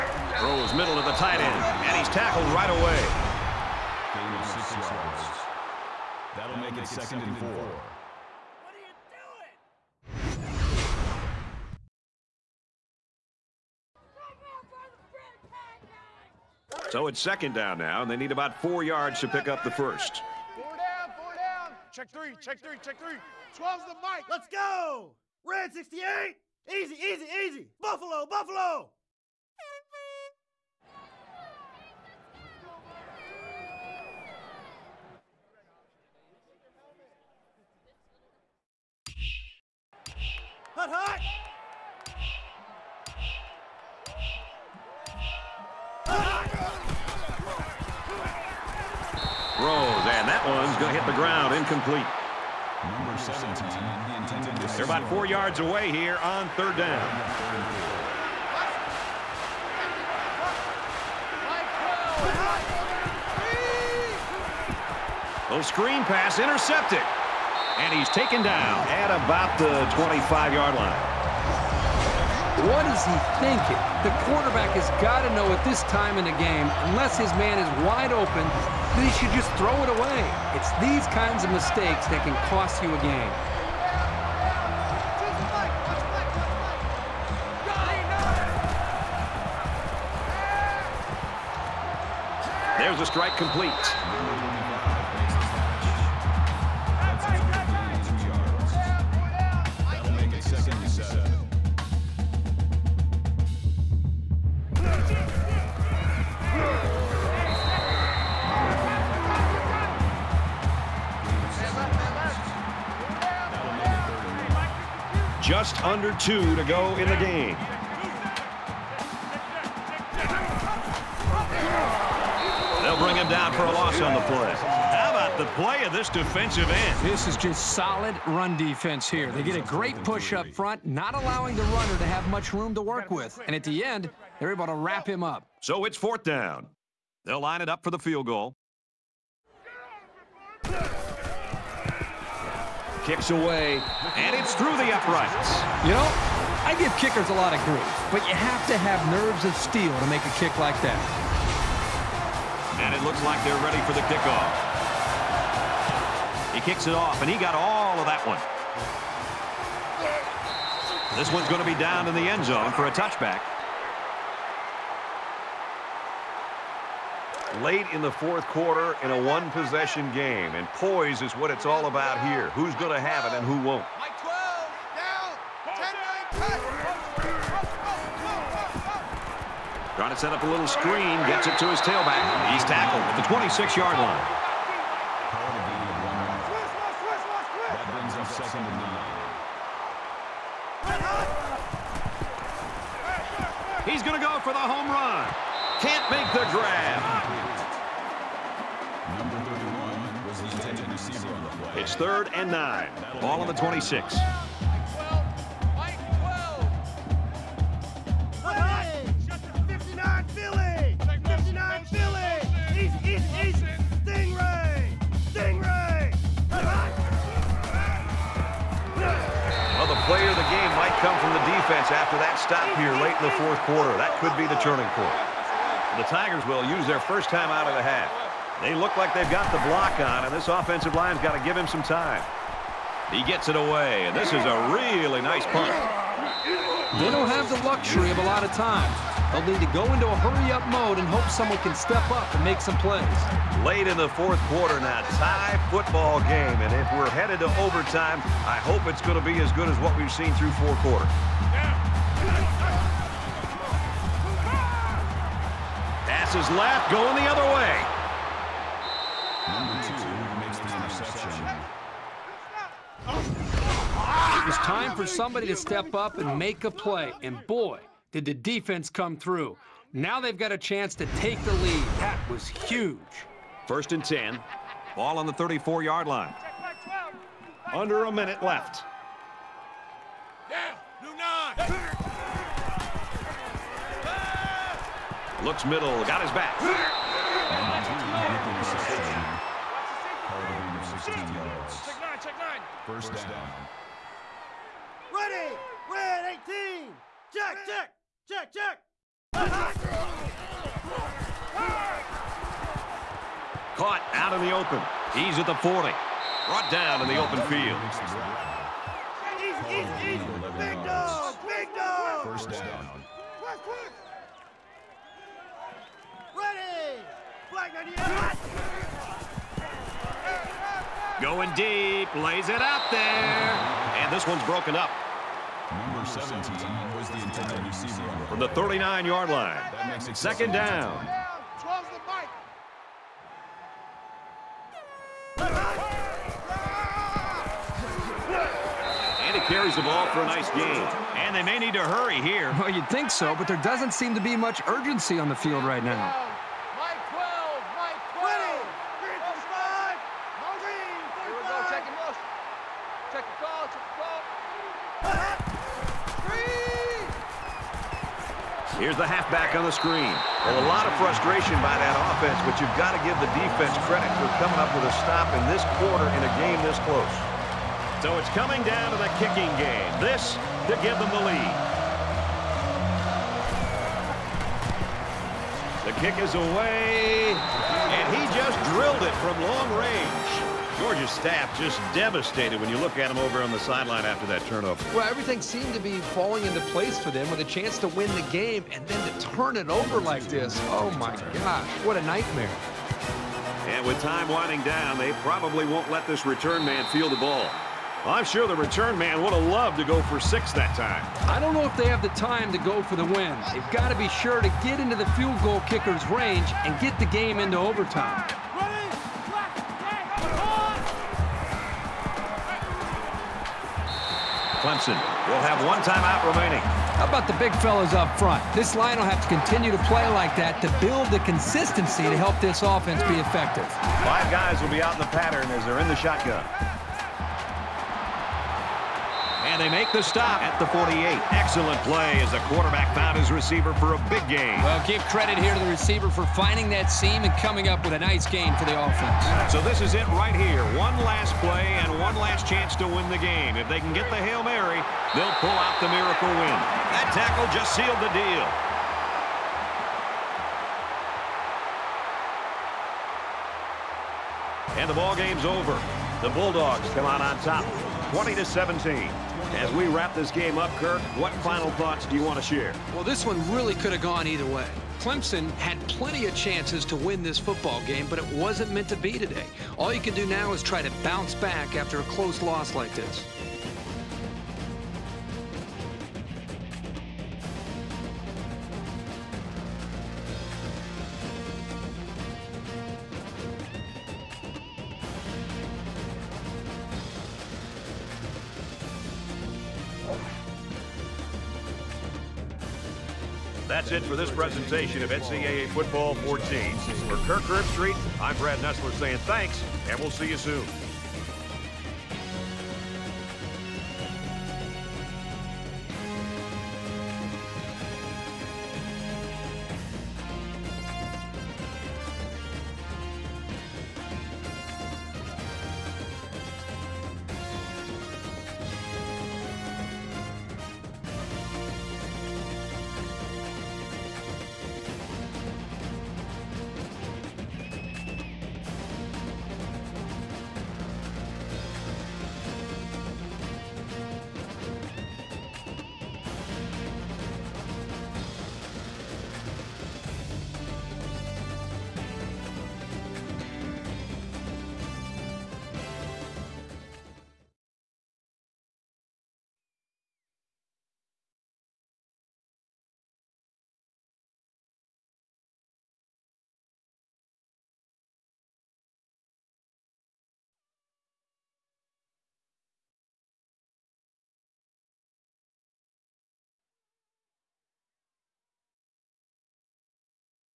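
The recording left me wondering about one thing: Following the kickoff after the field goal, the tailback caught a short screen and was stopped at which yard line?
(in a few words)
26-yard line.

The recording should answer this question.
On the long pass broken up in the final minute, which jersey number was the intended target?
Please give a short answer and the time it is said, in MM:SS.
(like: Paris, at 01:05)
17, at 05:25.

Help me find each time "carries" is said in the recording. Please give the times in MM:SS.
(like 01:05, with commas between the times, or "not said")
05:39.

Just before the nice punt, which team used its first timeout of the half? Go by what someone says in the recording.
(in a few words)
Tigers.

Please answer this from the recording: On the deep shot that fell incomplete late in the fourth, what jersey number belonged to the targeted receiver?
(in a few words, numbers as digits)
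31.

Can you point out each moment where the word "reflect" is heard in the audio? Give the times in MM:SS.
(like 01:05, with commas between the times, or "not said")
not said.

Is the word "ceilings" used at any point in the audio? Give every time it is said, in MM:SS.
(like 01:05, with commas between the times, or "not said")
not said.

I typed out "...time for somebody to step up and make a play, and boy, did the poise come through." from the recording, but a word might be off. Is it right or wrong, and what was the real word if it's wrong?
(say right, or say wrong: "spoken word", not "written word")
wrong: "defense", not "poise".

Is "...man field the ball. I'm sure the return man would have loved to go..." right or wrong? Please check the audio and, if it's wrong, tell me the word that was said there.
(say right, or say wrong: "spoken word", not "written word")
right.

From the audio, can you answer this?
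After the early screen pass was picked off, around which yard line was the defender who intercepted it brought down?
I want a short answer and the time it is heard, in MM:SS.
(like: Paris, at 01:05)
25-yard line, at 01:09.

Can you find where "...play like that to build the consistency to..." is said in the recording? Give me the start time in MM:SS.
06:59.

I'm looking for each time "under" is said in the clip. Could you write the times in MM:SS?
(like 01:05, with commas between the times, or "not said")
01:55, 04:37.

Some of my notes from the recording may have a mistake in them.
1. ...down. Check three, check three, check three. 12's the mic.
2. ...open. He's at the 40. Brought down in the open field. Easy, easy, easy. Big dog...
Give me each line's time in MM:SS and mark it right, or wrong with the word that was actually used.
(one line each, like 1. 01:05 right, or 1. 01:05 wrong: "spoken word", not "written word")
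1. 00:21 right
2. 05:04 right.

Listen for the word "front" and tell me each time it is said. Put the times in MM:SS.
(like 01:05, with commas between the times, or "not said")
02:10, 06:58.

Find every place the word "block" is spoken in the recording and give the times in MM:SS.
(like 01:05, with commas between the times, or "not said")
03:49.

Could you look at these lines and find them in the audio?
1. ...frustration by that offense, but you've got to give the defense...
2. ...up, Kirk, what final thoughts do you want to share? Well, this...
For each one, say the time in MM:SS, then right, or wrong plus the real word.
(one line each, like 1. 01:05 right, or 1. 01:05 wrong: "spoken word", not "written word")
1. 06:00 right
2. 07:40 right.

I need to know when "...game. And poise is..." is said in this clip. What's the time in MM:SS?
02:50.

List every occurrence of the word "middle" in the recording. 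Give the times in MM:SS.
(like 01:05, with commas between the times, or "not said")
00:00, 04:45.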